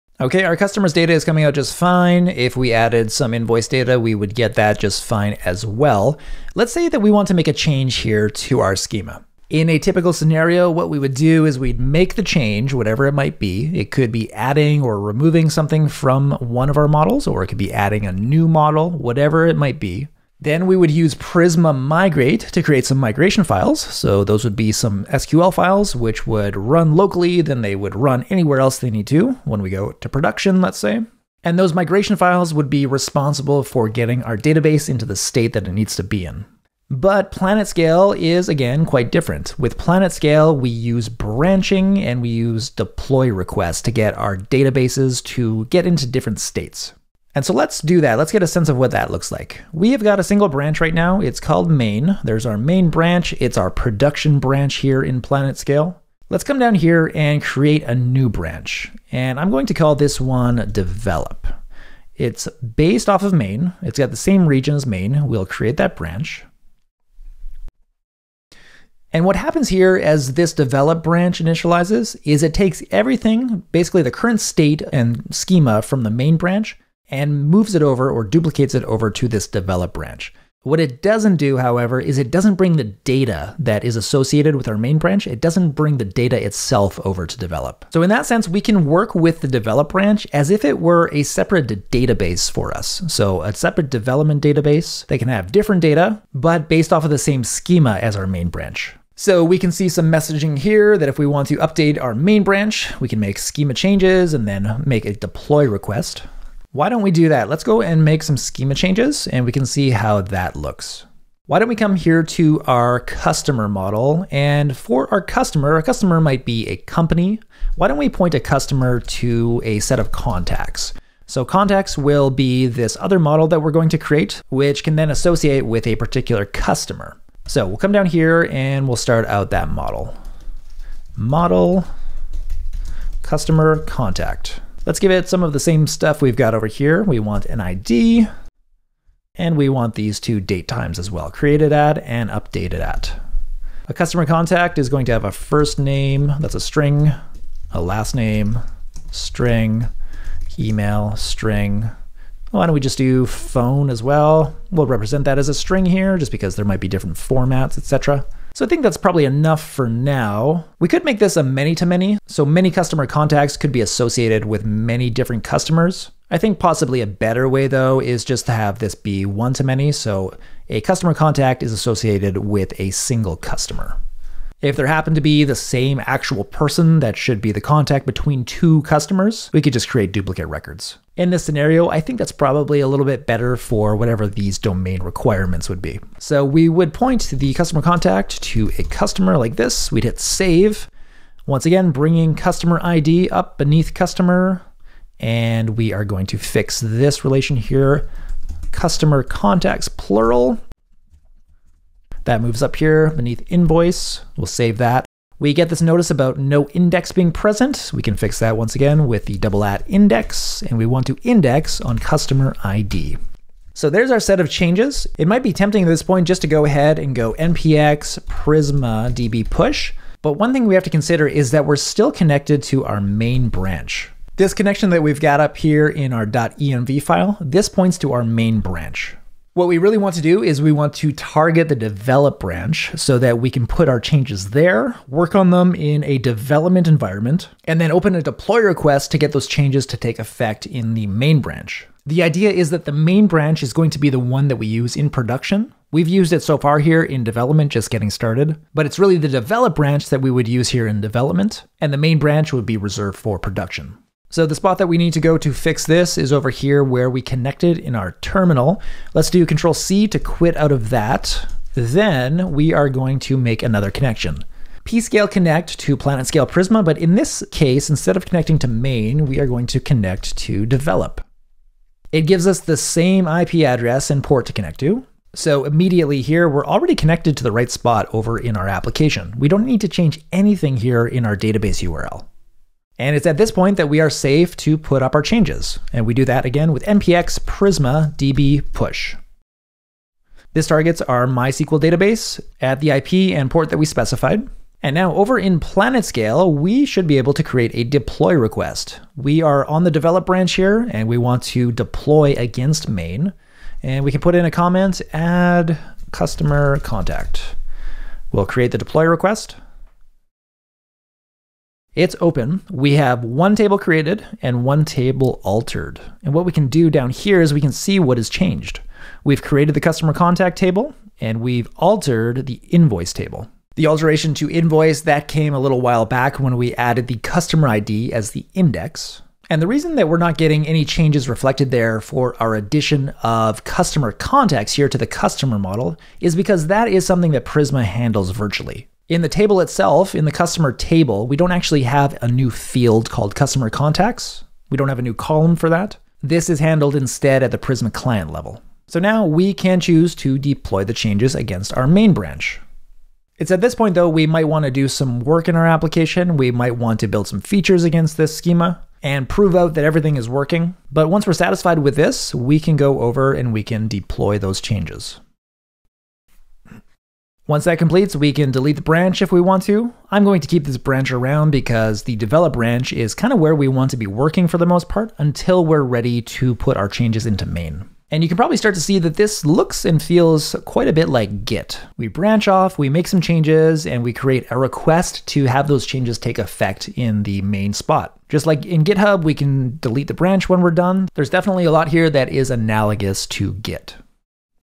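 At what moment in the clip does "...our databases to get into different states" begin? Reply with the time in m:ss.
0:44.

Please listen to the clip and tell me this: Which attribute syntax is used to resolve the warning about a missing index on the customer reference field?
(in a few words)
double at index.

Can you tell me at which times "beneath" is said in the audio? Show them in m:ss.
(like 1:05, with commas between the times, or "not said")
3:13, 3:23.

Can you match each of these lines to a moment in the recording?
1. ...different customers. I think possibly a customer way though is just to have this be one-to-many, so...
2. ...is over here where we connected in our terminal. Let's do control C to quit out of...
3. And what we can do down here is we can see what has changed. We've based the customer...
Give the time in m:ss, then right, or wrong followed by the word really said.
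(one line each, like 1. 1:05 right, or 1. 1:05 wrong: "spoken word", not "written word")
1. 2:45 wrong: "better", not "customer"
2. 4:16 right
3. 5:16 wrong: "created", not "based".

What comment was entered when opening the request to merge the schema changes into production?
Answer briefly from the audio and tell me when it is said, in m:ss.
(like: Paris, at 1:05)
add customer contact, at 5:05.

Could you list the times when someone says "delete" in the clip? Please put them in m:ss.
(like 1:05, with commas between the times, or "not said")
6:08, 6:29.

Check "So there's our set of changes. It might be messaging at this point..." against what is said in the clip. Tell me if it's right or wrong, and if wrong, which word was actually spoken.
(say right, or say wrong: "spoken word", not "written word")
wrong: "tempting", not "messaging".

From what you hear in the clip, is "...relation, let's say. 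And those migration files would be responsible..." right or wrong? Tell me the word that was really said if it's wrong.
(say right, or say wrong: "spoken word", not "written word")
wrong: "production", not "relation".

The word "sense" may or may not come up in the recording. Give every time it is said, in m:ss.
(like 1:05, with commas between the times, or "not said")
0:48, 1:28.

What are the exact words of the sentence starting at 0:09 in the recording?
In a typical scenario, what we would do is we'd make the change, whatever it might be.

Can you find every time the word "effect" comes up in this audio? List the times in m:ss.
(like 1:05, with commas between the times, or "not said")
4:00, 6:26.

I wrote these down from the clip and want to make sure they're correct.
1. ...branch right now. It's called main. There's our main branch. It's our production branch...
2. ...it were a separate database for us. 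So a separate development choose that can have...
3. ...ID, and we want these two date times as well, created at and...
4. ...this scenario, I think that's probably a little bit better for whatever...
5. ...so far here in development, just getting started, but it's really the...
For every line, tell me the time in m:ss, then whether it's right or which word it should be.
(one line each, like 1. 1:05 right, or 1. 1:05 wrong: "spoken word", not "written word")
1. 0:50 right
2. 1:30 wrong: "database", not "choose"
3. 2:17 right
4. 3:01 right
5. 4:06 right.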